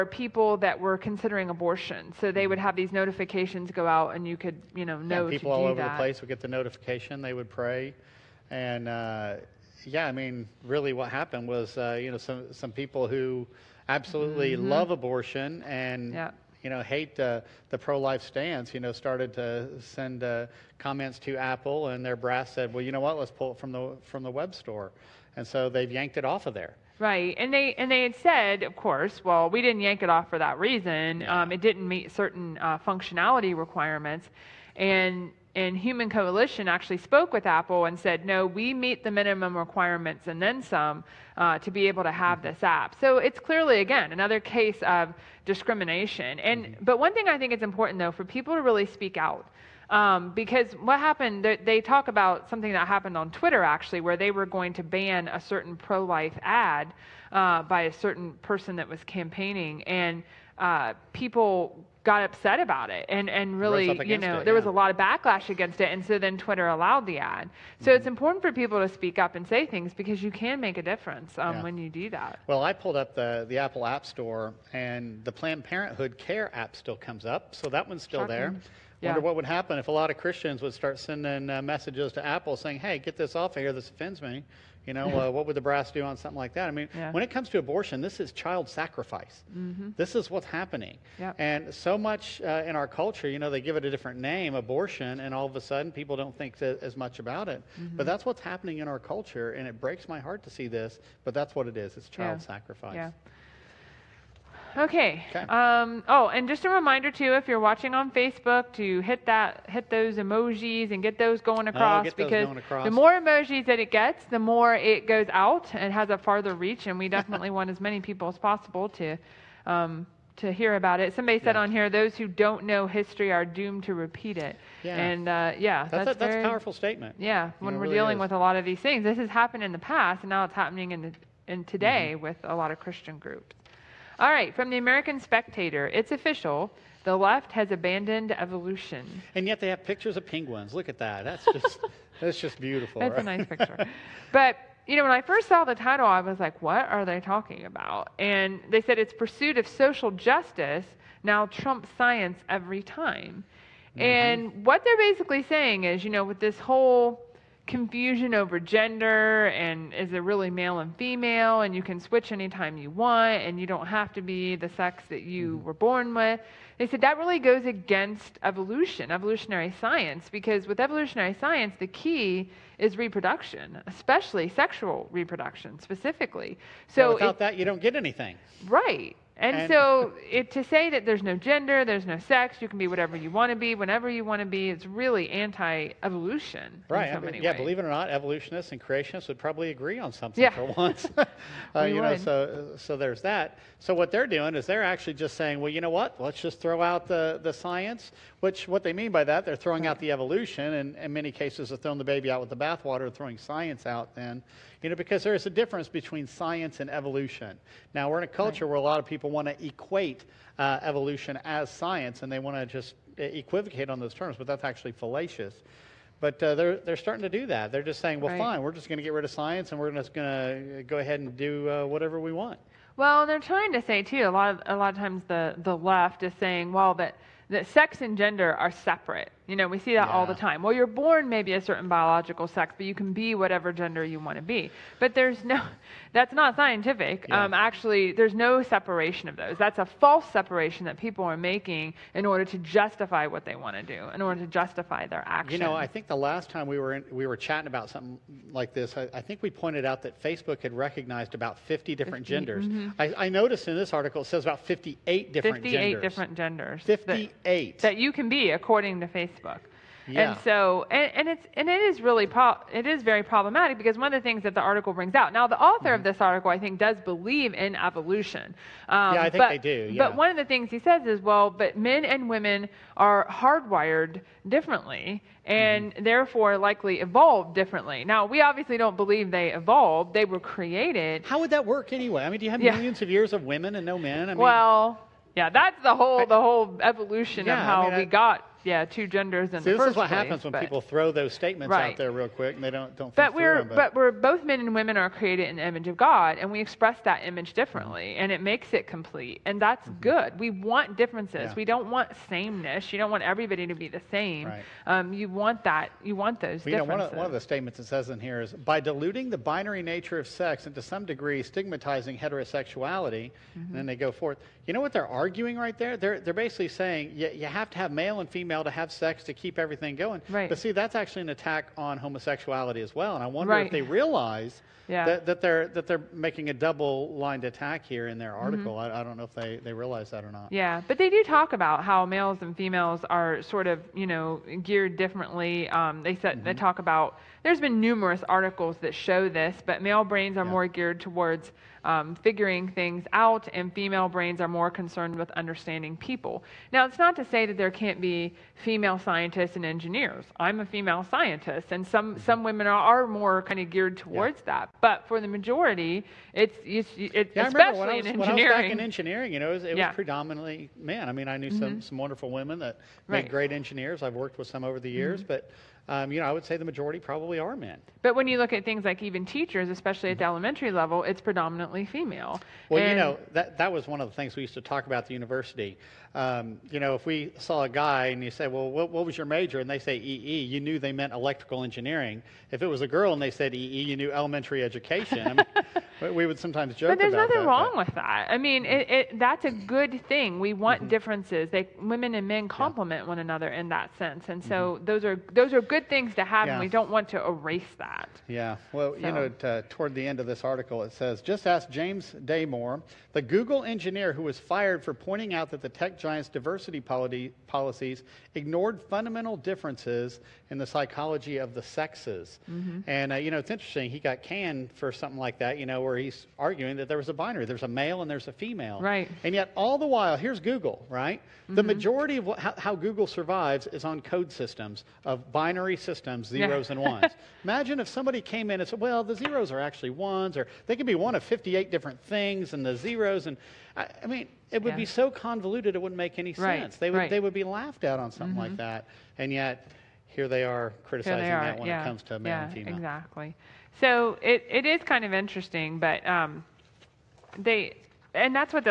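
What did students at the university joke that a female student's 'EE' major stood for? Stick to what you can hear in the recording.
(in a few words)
Elementary education.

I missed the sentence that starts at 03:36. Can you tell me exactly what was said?
But uh, they're, they're starting to do that.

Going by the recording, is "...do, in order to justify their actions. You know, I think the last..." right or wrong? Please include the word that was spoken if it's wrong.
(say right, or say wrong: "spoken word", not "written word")
right.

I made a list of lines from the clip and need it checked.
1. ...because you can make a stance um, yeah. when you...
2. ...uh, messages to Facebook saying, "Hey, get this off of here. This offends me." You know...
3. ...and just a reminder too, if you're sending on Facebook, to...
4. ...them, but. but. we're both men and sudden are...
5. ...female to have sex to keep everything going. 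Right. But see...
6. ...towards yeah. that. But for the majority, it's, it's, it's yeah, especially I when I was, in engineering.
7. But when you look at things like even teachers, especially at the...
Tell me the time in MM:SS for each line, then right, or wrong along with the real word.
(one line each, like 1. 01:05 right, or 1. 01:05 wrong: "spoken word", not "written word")
1. 01:09 wrong: "difference", not "stance"
2. 01:21 wrong: "Apple", not "Facebook"
3. 01:46 wrong: "watching", not "sending"
4. 04:53 wrong: "women", not "sudden"
5. 05:18 right
6. 05:53 right
7. 06:08 right.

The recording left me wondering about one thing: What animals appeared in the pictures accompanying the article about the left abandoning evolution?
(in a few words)
Penguins.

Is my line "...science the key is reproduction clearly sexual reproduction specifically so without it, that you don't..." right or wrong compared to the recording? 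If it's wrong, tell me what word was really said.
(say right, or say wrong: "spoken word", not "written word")
wrong: "especially", not "clearly".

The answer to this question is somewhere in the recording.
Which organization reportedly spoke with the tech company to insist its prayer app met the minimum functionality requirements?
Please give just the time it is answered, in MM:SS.
00:35.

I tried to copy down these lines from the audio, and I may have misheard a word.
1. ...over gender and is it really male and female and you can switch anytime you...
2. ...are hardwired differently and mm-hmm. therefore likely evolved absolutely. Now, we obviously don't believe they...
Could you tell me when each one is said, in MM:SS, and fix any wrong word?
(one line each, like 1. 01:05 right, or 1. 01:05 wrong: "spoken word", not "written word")
1. 02:38 right
2. 04:32 wrong: "differently", not "absolutely".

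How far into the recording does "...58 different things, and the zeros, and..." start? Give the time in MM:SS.
07:11.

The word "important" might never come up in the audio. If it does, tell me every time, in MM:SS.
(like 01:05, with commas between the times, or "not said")
00:47, 01:08.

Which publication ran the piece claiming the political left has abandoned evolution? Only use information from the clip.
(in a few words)
The American Spectator.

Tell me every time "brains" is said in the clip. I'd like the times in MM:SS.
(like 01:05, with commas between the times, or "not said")
05:40, 05:44.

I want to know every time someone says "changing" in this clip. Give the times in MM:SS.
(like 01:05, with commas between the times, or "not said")
not said.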